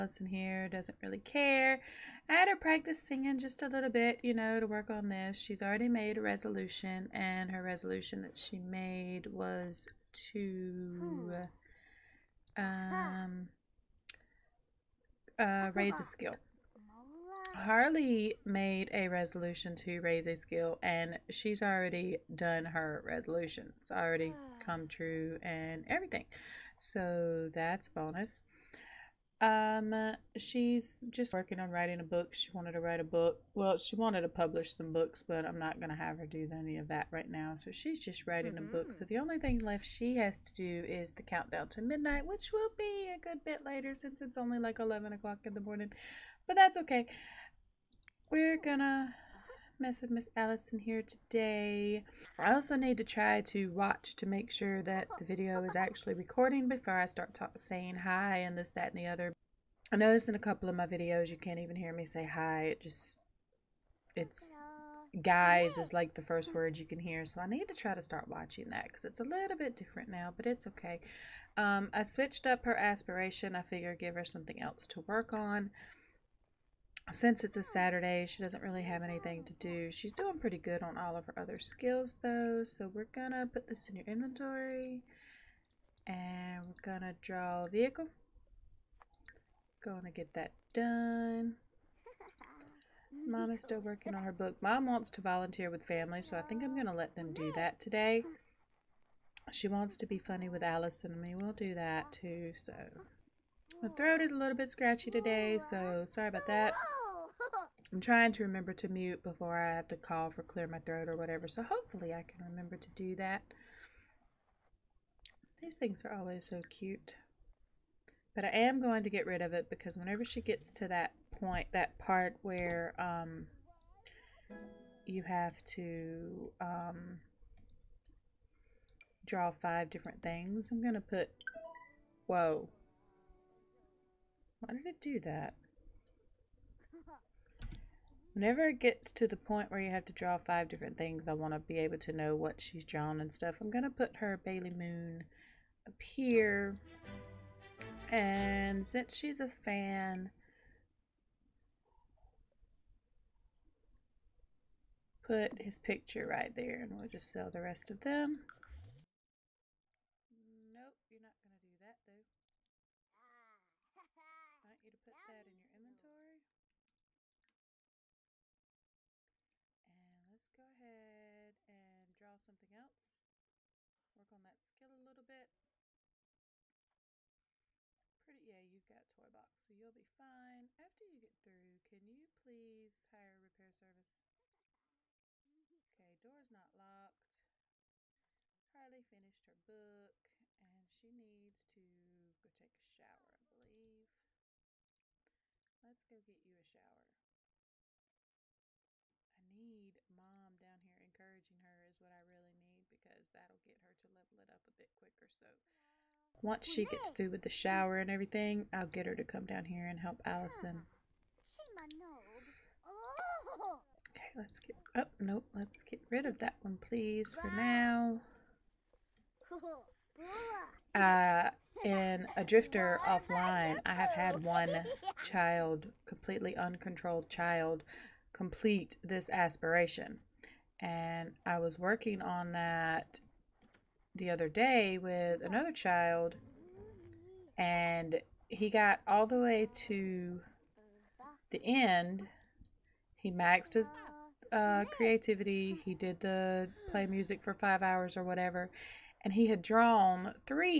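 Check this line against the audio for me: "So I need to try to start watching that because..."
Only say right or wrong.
right.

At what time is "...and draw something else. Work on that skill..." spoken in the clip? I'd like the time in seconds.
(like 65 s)
171 s.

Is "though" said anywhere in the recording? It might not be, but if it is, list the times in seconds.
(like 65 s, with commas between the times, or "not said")
82 s, 162 s.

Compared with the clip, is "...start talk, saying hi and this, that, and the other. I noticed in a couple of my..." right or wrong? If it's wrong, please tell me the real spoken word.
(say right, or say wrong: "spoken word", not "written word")
right.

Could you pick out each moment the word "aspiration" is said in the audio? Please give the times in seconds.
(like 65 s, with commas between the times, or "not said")
72 s, 229 s.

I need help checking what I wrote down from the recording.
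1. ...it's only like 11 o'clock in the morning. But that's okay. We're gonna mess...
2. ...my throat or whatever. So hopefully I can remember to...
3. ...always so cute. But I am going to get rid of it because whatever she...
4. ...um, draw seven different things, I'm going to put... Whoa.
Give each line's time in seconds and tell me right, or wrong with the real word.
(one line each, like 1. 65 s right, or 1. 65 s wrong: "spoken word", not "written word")
1. 44 s right
2. 110 s right
3. 116 s wrong: "whenever", not "whatever"
4. 126 s wrong: "five", not "seven".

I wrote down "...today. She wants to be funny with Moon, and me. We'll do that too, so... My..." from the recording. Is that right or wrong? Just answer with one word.
wrong.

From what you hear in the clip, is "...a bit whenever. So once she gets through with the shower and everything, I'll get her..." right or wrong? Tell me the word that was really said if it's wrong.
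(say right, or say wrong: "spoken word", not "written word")
wrong: "quicker", not "whenever".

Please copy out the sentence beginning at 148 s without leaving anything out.
And since she's a fan, put his picture right there and we'll just sell the rest of them.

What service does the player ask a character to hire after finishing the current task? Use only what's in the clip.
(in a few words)
Repair service.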